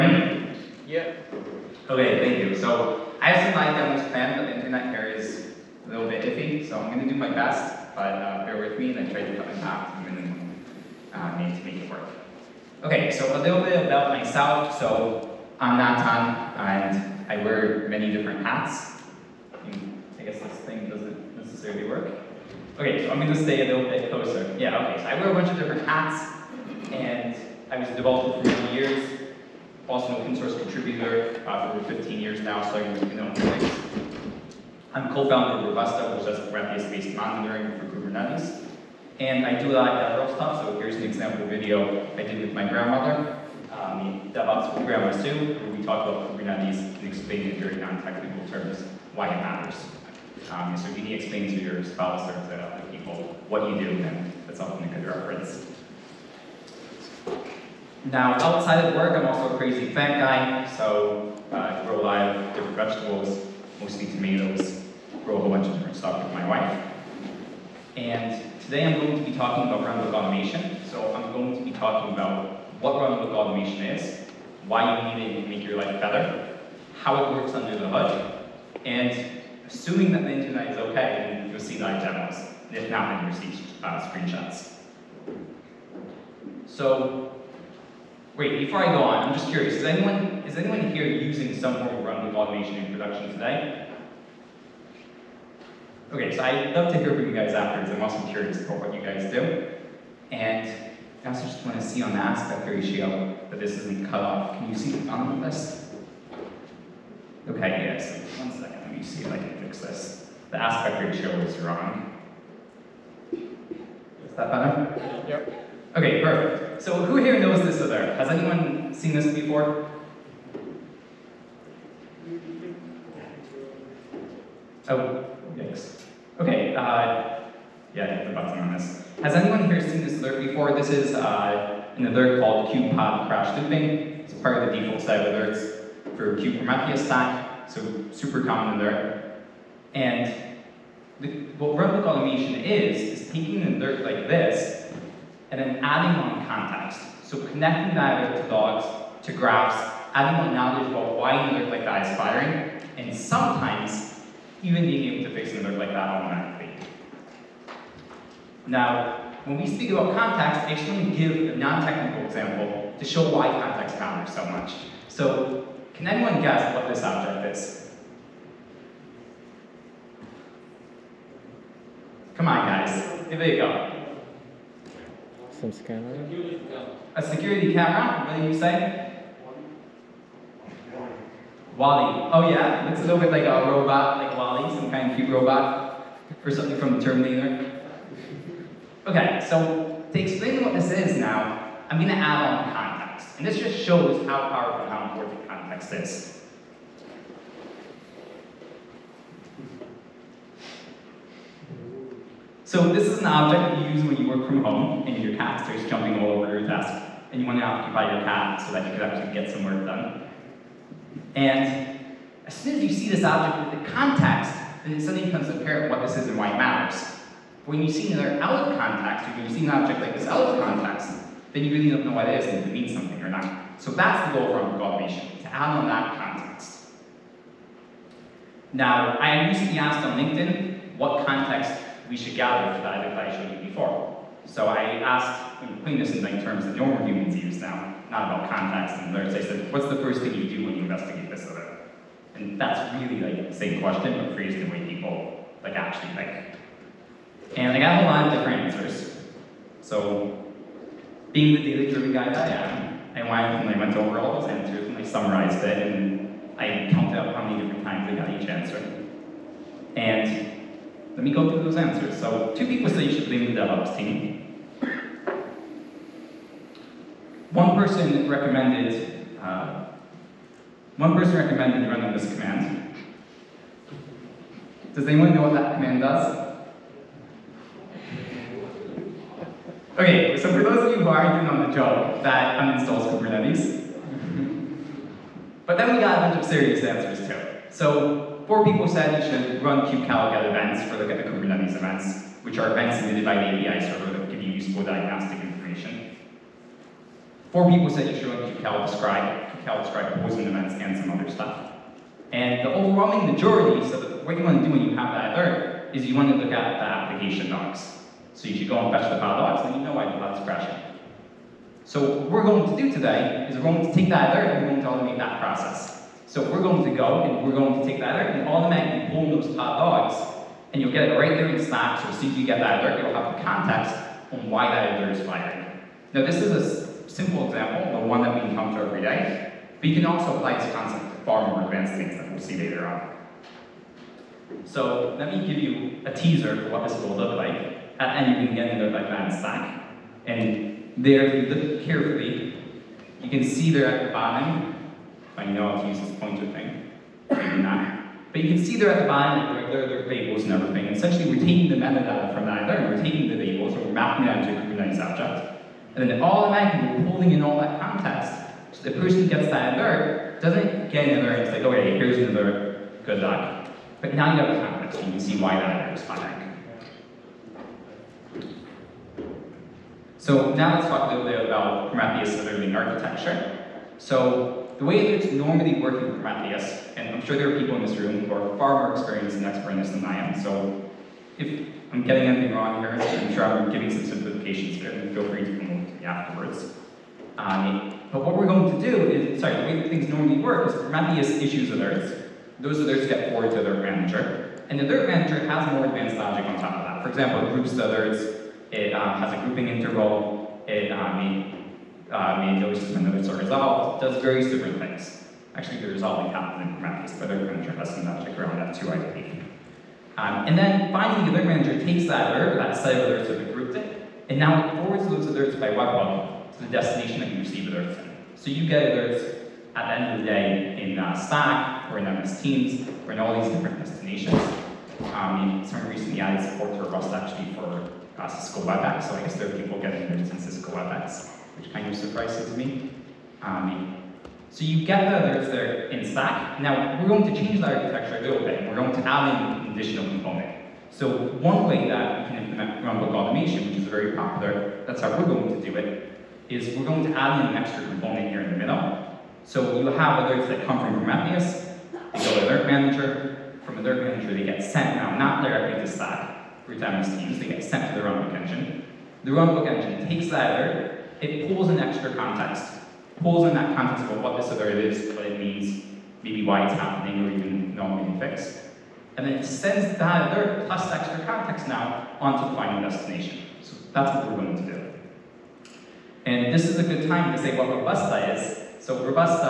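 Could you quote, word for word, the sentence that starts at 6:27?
Um, but what we're going to do is, sorry, the way that things normally work is Prometheus issues alerts.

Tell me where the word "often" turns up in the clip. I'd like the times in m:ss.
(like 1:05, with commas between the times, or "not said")
0:54.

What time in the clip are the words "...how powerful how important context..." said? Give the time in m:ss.
3:14.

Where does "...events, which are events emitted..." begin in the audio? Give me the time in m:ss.
4:51.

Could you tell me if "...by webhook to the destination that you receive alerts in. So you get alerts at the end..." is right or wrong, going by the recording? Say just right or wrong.
right.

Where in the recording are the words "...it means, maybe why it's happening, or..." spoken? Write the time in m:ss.
7:45.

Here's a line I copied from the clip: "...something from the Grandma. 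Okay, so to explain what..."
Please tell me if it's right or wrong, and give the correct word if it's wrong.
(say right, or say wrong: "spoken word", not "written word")
wrong: "Terminator", not "Grandma".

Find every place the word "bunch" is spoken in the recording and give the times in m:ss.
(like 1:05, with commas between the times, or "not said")
0:25, 1:05, 4:46.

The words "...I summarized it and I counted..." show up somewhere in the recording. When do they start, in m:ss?
4:14.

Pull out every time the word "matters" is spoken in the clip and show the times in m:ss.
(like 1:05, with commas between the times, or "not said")
0:49, 2:43, 3:36.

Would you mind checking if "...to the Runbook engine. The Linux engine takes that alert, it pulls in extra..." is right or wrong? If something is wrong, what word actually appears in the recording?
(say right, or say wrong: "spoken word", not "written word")
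wrong: "Runbook", not "Linux".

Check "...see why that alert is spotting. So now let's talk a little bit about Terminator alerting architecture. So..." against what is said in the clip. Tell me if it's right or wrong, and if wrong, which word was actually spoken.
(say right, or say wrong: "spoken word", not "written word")
wrong: "Prometheus", not "Terminator".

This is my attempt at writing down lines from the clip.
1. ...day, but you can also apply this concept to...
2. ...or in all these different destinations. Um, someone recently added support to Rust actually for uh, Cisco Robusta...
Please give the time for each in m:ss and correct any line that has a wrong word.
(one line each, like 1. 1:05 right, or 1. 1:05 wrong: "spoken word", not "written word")
1. 5:29 right
2. 7:03 wrong: "WebEx", not "Robusta".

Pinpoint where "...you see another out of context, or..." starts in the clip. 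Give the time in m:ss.
3:37.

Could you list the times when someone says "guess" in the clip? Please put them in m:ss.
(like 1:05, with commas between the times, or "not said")
0:20, 2:46, 7:09.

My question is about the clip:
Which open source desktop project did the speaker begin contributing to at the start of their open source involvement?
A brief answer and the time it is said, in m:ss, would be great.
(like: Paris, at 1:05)
GNOME, at 0:33.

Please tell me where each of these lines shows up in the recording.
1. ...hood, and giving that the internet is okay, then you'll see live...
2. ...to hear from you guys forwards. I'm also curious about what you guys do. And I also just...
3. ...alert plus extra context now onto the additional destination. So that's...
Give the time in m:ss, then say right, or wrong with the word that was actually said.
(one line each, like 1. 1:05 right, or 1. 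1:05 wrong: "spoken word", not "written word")
1. 1:17 wrong: "assuming", not "giving"
2. 1:36 wrong: "afterwards", not "forwards"
3. 7:50 wrong: "final", not "additional".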